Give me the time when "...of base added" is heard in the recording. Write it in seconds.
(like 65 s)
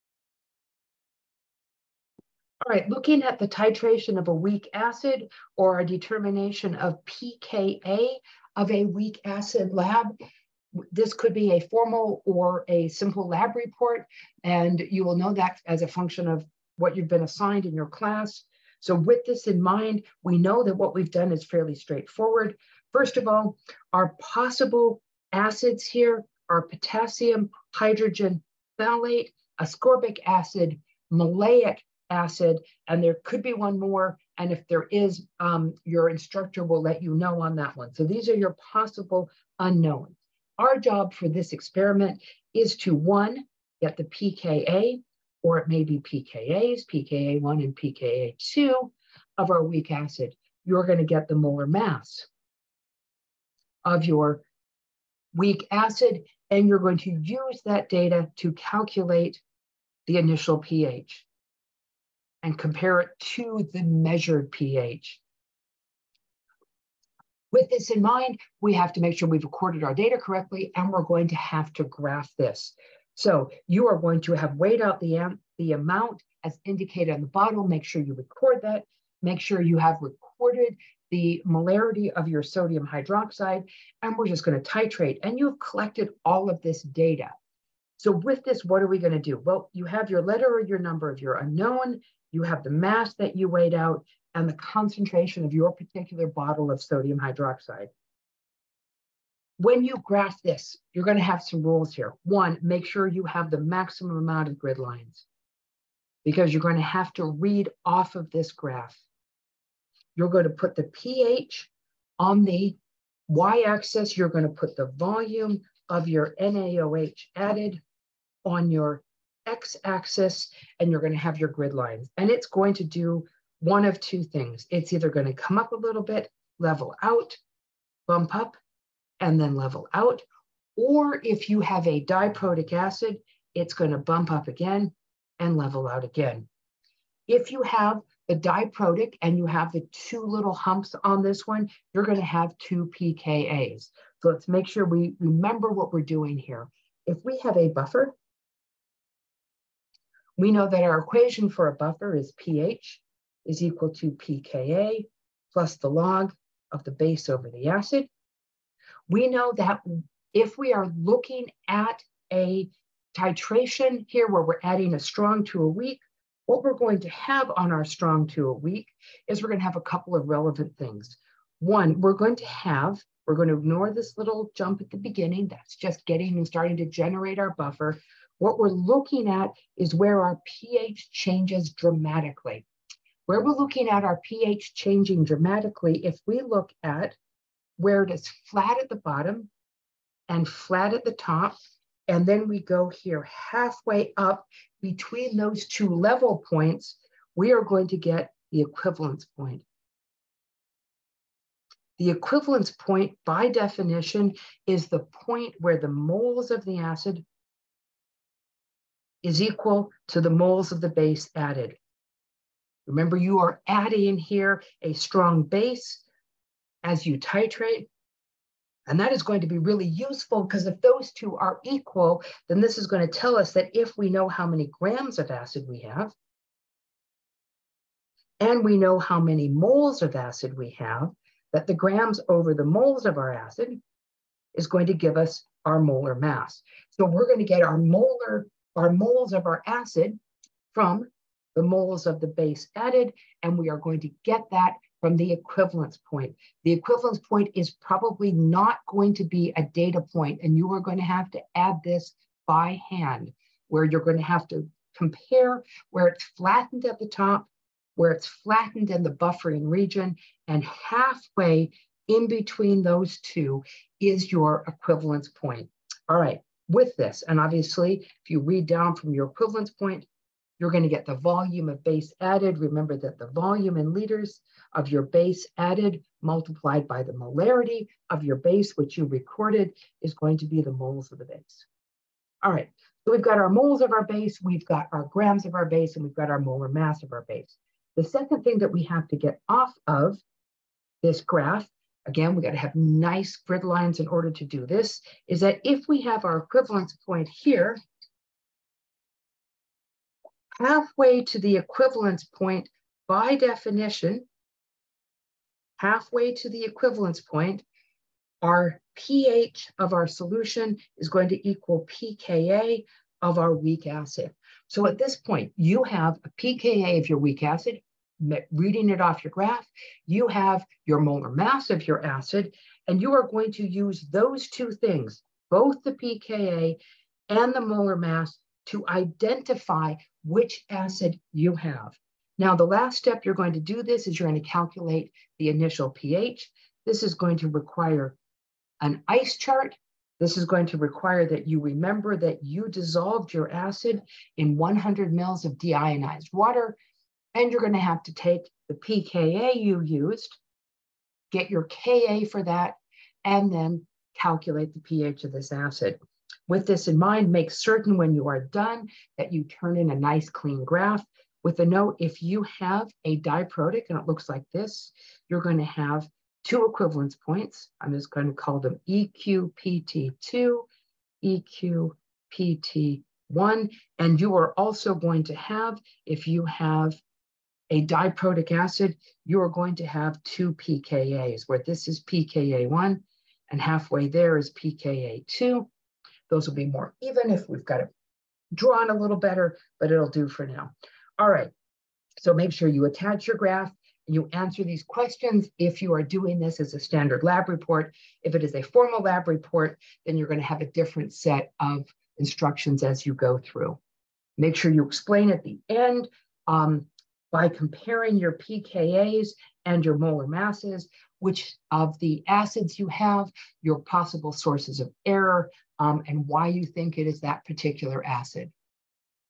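271 s.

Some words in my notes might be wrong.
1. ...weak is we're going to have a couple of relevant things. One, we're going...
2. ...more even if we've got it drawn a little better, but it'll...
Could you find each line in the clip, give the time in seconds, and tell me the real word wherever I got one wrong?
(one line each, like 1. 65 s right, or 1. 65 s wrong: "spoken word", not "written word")
1. 168 s right
2. 386 s right.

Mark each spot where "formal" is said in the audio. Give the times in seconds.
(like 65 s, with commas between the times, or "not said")
11 s, 398 s.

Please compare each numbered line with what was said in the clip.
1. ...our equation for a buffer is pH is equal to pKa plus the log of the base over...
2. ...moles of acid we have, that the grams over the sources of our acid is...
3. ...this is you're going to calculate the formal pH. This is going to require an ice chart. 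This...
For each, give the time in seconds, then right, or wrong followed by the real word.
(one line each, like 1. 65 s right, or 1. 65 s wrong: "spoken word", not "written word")
1. 150 s right
2. 229 s wrong: "moles", not "sources"
3. 333 s wrong: "initial", not "formal".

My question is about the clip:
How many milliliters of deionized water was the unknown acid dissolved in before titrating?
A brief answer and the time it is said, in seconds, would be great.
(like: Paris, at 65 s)
100, at 344 s.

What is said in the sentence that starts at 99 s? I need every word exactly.
When you graph this, you're going to have some rules here.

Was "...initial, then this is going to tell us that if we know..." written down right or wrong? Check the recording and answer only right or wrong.
wrong.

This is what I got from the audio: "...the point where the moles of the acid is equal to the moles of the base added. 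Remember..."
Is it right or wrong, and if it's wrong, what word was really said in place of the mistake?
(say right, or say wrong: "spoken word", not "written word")
right.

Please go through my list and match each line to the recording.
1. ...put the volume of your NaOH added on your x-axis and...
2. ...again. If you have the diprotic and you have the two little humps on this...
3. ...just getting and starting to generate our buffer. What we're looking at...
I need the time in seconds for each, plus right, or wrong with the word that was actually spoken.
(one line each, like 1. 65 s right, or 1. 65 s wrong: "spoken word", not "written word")
1. 114 s right
2. 136 s right
3. 175 s right.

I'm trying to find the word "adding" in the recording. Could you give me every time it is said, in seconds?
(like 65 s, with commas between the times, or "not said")
164 s, 213 s.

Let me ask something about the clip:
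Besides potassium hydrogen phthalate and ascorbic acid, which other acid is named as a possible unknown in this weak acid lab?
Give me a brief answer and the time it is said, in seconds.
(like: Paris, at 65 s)
maleic acid, at 31 s.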